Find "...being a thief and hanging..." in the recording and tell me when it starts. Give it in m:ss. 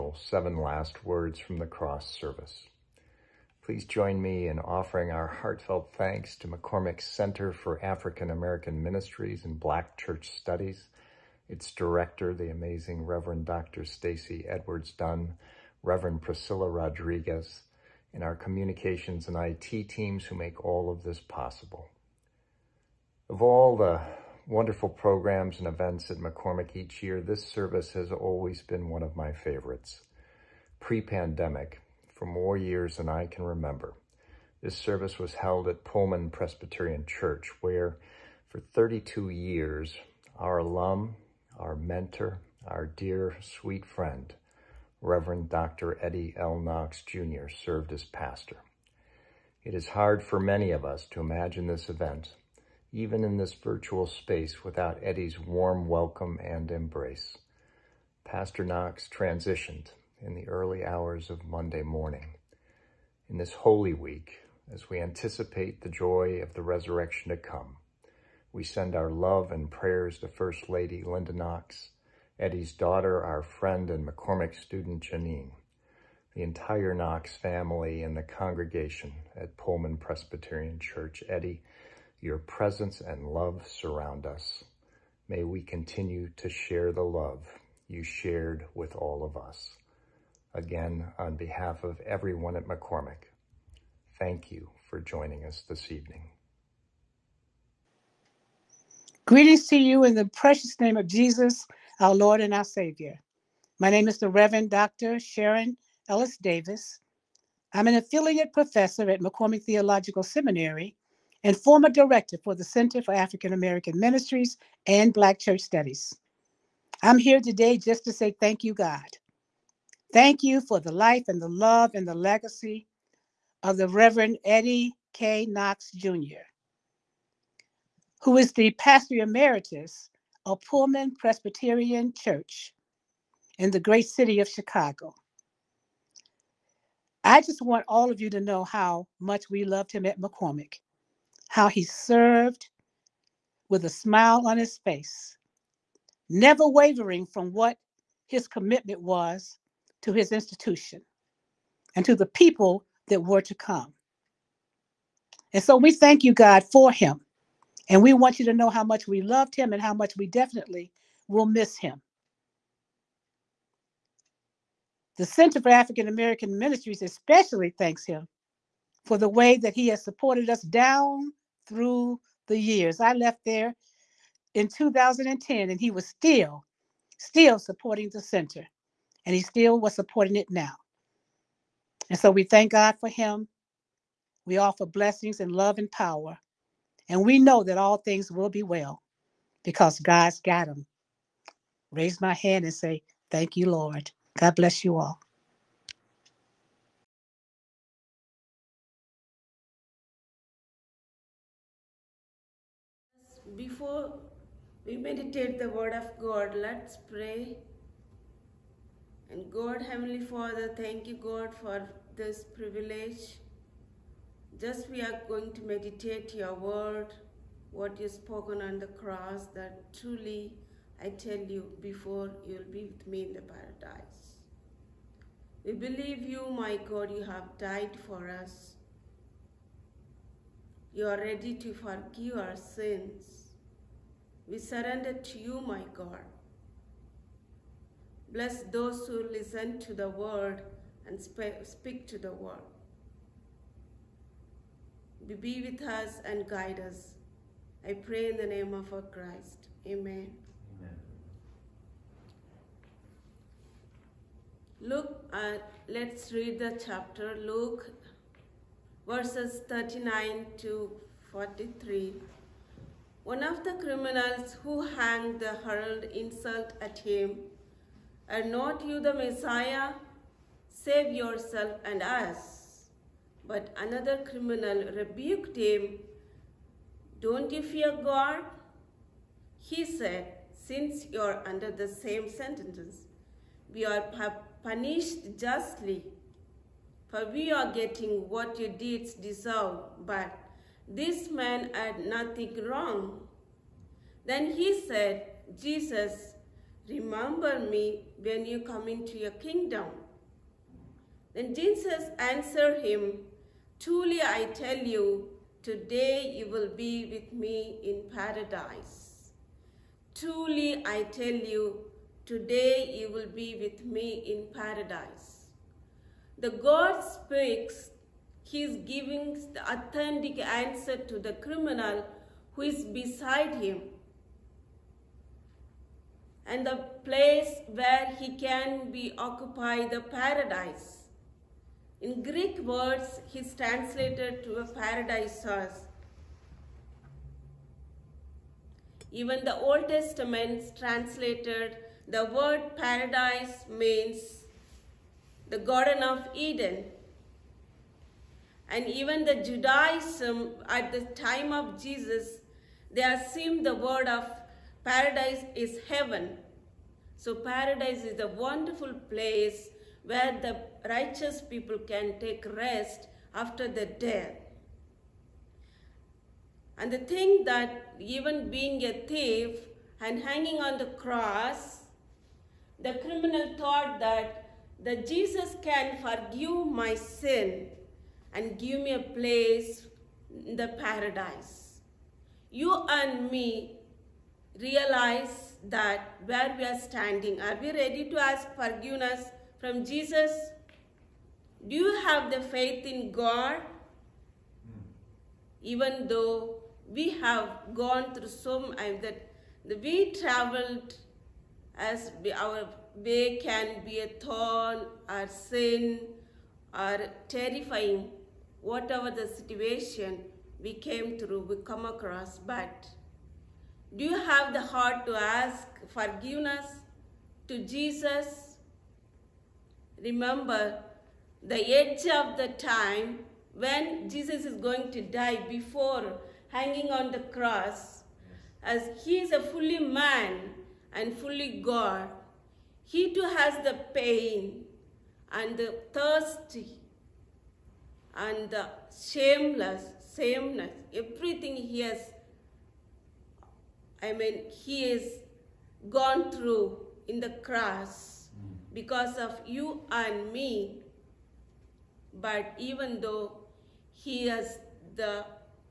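6:08.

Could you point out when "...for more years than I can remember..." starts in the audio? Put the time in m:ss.
0:32.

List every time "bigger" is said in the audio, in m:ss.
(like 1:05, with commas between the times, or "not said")
not said.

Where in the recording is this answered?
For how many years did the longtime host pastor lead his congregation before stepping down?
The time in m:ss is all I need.
0:38.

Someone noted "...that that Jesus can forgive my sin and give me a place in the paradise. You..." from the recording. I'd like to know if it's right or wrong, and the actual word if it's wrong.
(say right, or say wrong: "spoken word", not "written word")
right.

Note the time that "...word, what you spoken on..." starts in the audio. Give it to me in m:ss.
3:36.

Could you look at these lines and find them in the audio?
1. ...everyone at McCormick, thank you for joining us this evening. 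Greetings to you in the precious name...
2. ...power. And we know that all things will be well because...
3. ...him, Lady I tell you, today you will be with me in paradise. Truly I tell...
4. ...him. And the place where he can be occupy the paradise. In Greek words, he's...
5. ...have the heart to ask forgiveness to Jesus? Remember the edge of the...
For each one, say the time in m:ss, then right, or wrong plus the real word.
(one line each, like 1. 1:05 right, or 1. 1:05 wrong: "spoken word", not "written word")
1. 1:31 right
2. 3:05 right
3. 5:02 wrong: "Truly", not "Lady"
4. 5:23 right
5. 6:54 right.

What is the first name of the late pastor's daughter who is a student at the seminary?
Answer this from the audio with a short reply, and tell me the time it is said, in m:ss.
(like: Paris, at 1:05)
Janine, at 1:15.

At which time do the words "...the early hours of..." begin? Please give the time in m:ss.
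1:00.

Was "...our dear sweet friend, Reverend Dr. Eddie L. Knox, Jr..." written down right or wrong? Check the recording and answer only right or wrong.
right.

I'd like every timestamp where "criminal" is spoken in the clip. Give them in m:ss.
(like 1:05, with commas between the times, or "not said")
4:23, 4:34, 5:21, 6:12.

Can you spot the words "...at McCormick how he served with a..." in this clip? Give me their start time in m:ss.
2:20.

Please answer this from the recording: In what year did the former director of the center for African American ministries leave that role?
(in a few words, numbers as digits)
2010.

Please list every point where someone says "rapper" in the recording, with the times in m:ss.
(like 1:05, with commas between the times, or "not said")
not said.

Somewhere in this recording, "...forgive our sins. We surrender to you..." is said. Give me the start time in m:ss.
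3:51.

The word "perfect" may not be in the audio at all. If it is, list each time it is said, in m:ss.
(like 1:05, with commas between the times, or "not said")
not said.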